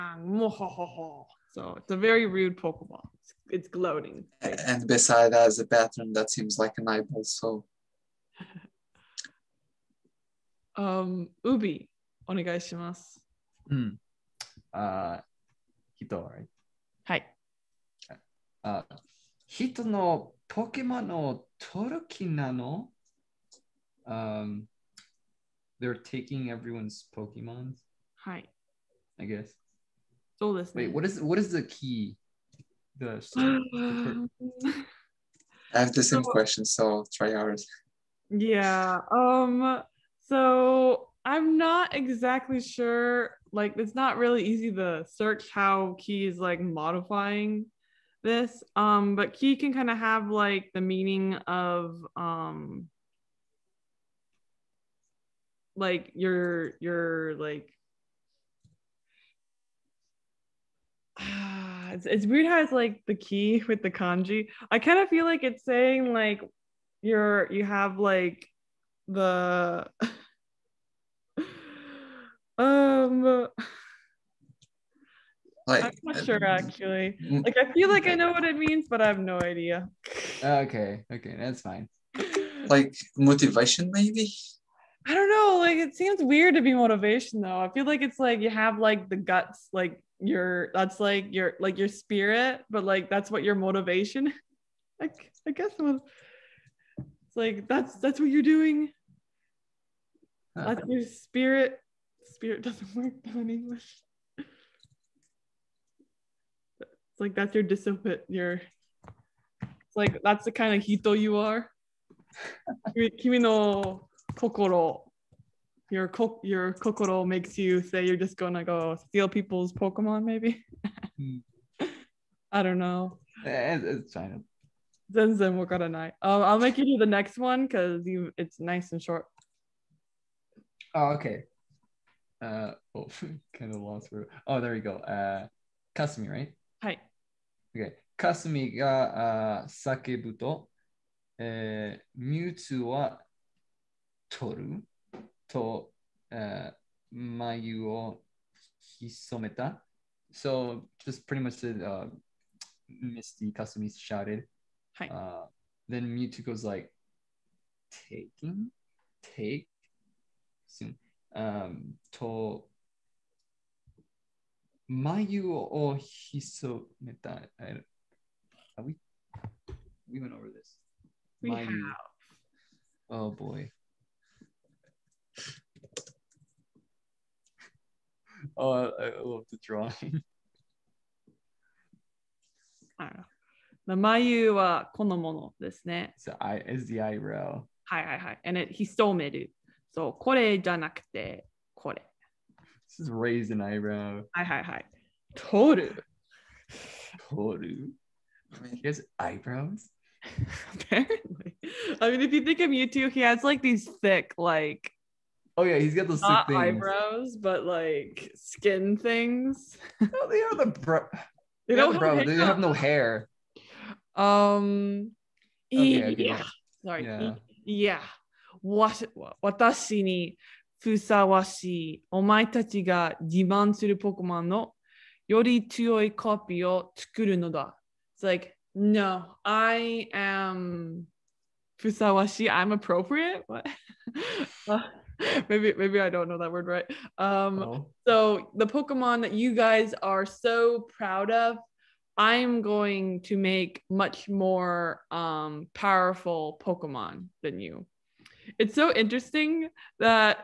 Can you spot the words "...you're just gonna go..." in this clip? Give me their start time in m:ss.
1:58.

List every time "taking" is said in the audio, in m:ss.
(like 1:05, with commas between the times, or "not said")
0:25, 2:38.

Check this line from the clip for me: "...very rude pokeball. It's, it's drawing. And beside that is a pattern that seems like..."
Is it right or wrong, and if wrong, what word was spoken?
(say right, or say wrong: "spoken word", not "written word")
wrong: "gloating", not "drawing".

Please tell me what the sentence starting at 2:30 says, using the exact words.
So just pretty much the uh, Misty Kasumi shouted.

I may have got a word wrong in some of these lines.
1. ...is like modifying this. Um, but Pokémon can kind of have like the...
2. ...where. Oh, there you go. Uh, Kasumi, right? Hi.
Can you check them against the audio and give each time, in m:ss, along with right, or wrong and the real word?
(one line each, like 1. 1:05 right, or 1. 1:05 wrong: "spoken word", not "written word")
1. 0:46 wrong: "Key", not "Pokémon"
2. 2:14 right.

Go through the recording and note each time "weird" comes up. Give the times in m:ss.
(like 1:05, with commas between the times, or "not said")
1:02, 1:26.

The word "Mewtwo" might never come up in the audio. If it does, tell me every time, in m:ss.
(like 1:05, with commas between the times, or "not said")
2:22, 3:22.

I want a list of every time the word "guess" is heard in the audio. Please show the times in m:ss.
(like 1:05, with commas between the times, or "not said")
0:29, 1:35.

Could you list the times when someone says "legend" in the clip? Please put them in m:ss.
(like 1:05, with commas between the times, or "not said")
not said.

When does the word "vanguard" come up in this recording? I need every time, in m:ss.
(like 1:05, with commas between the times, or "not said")
not said.